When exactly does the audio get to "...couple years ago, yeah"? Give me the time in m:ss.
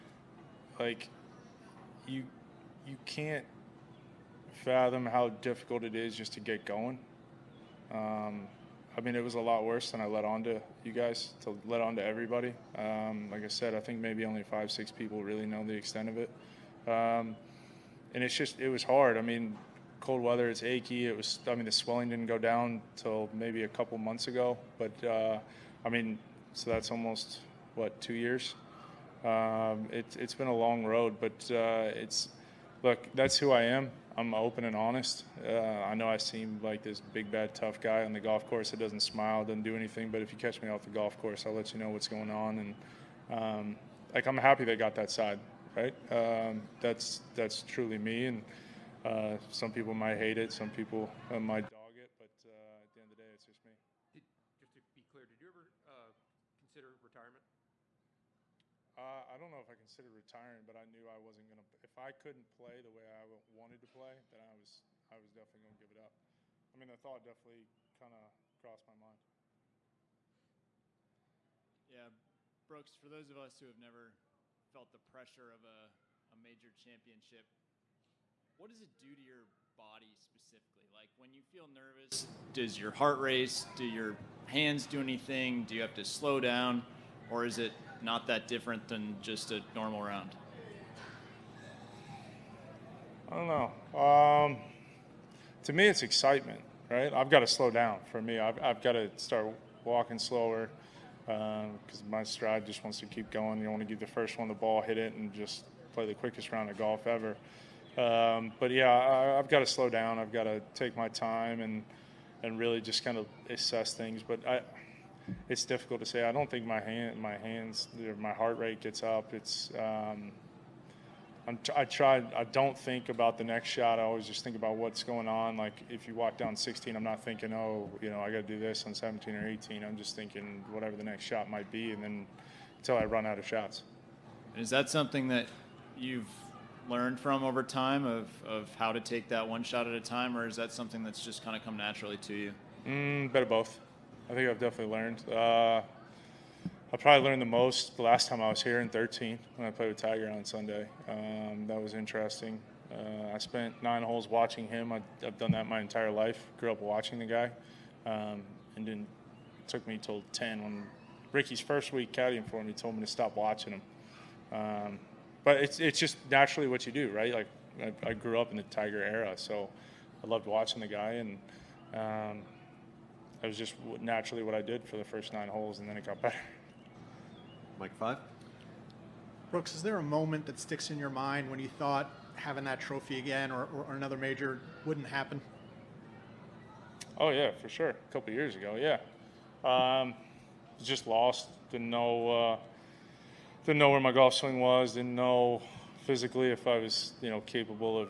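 3:08.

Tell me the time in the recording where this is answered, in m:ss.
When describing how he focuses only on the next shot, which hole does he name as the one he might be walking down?
2:06.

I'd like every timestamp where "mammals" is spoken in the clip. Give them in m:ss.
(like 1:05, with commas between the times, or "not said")
not said.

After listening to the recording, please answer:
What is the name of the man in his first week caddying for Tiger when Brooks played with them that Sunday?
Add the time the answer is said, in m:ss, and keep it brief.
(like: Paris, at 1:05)
Ricky, at 2:41.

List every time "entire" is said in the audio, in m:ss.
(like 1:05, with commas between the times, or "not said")
2:35.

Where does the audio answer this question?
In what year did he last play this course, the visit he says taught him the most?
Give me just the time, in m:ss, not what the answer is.
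2:28.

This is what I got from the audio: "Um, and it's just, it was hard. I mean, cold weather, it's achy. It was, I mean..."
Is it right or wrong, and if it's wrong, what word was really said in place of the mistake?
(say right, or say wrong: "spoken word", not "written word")
right.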